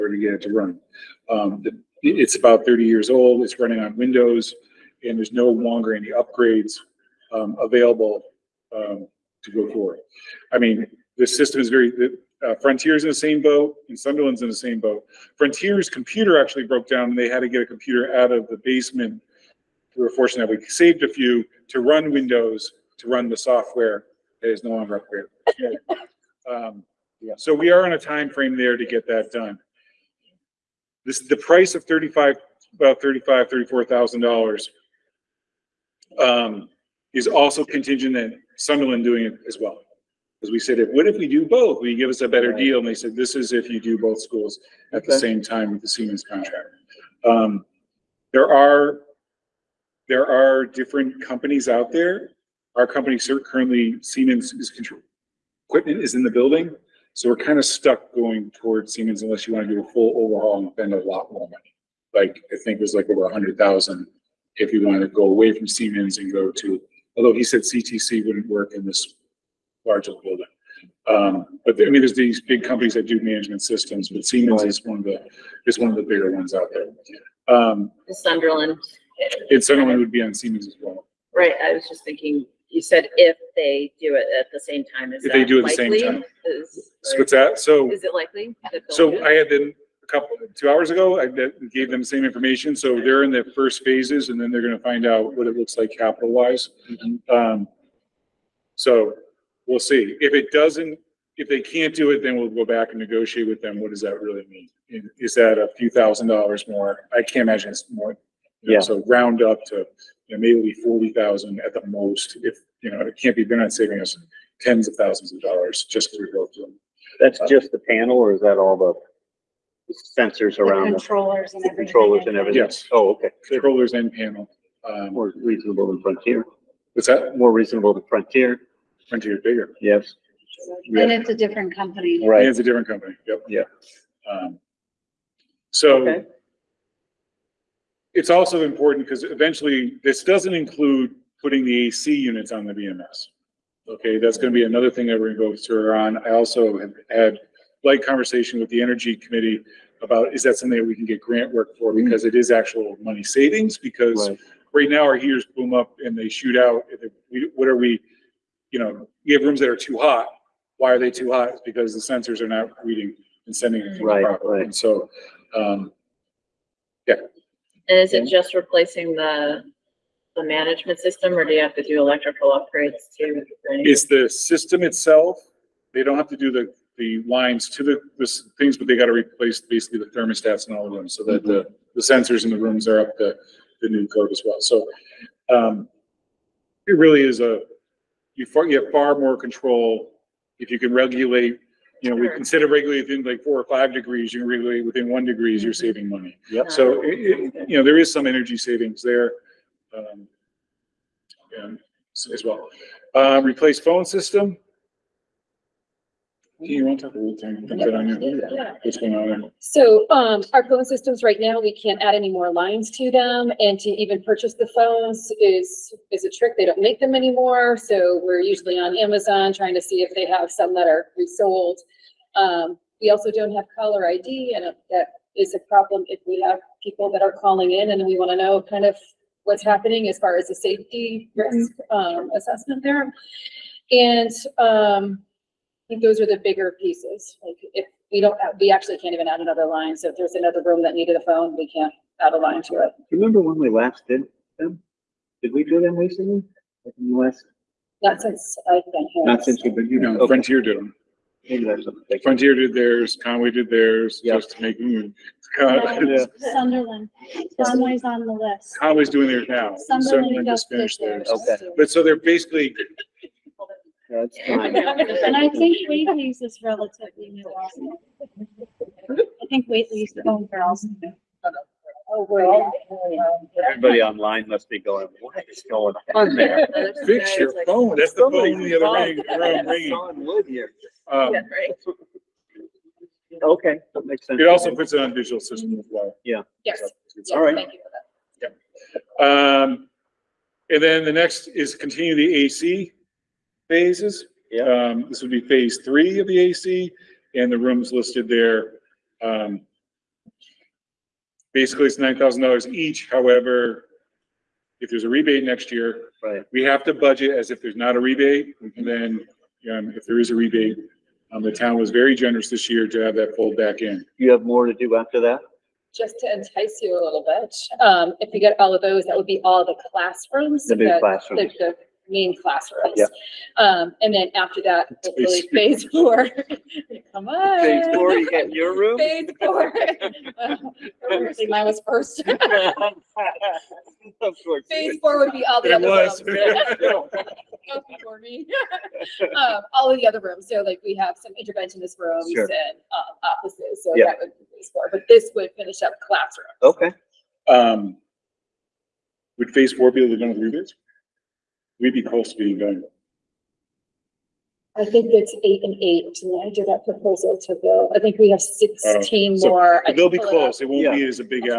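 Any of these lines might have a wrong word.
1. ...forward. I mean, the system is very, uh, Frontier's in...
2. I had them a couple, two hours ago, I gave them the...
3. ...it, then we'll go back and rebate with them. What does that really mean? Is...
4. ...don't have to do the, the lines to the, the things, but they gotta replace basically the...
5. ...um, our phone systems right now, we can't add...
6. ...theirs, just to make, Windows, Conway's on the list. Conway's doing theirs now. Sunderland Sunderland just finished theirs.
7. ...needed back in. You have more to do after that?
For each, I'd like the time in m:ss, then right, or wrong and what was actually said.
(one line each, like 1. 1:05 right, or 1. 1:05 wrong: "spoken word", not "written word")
1. 0:09 right
2. 1:29 right
3. 1:42 wrong: "negotiate", not "rebate"
4. 2:56 right
5. 3:30 right
6. 4:13 wrong: "Sunderland", not "Windows"
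7. 5:13 wrong: "pulled", not "needed".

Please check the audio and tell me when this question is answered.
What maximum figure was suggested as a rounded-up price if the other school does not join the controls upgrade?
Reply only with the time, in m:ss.
1:50.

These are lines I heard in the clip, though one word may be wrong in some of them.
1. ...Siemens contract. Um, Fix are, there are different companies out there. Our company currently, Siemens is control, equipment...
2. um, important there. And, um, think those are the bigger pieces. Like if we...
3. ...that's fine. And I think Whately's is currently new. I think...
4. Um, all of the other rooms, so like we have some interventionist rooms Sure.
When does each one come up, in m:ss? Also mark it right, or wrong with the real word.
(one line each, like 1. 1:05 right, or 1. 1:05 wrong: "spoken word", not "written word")
1. 0:45 wrong: "There", not "Fix"
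2. 3:51 wrong: "assessment", not "important"
3. 4:24 wrong: "relatively", not "currently"
4. 5:39 right.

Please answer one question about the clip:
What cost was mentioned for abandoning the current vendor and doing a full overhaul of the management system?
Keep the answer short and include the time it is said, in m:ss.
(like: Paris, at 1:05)
over $100,000, at 1:03.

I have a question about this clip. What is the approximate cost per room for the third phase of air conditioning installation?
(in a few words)
$9,000.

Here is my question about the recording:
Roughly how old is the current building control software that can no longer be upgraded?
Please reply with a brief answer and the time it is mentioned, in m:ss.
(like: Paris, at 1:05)
30 years, at 0:02.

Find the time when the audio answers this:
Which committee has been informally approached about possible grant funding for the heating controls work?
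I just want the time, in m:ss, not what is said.
2:28.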